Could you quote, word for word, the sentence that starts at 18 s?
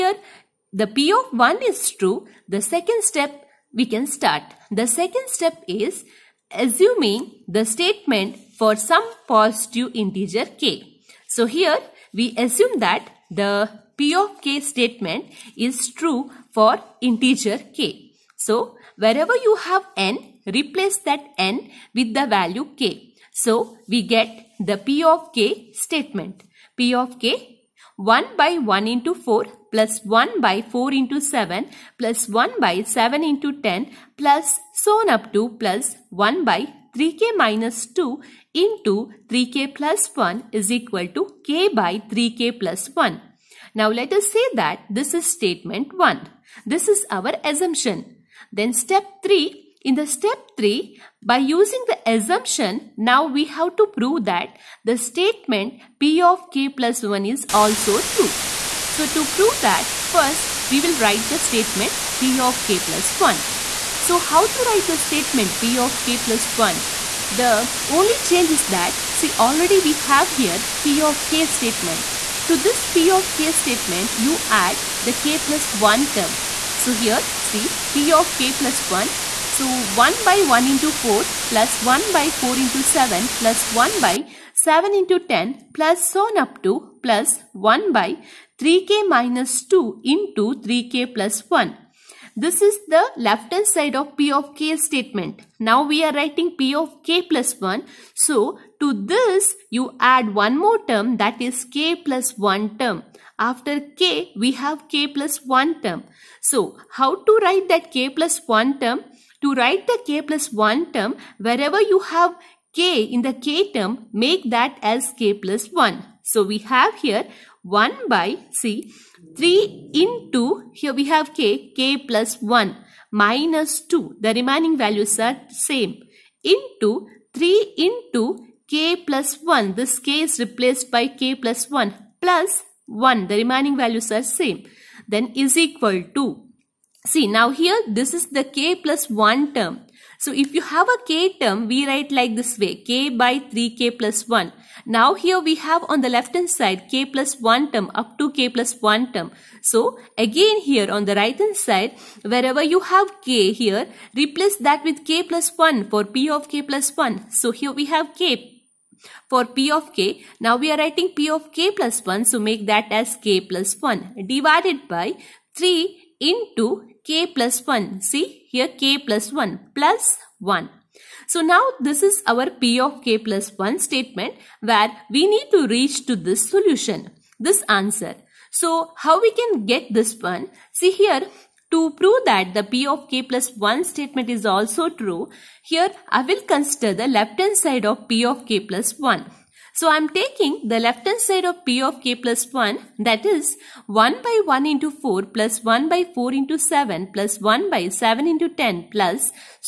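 So wherever you have n, replace that n with the value k.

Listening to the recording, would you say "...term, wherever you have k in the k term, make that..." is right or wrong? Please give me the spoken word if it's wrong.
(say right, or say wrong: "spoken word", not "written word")
right.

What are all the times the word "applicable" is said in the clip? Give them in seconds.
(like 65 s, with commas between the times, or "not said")
not said.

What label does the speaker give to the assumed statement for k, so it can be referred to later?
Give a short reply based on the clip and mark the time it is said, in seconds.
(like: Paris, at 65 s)
statement 1, at 45 s.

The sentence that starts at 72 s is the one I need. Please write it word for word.
To this P of k statement, you add the k plus 1 term.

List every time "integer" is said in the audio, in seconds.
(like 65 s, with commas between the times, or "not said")
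9 s, 16 s.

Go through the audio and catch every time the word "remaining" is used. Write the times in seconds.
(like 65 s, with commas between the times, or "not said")
124 s, 133 s.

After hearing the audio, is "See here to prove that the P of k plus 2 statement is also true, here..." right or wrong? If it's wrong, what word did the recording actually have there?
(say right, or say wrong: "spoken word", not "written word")
wrong: "1", not "2".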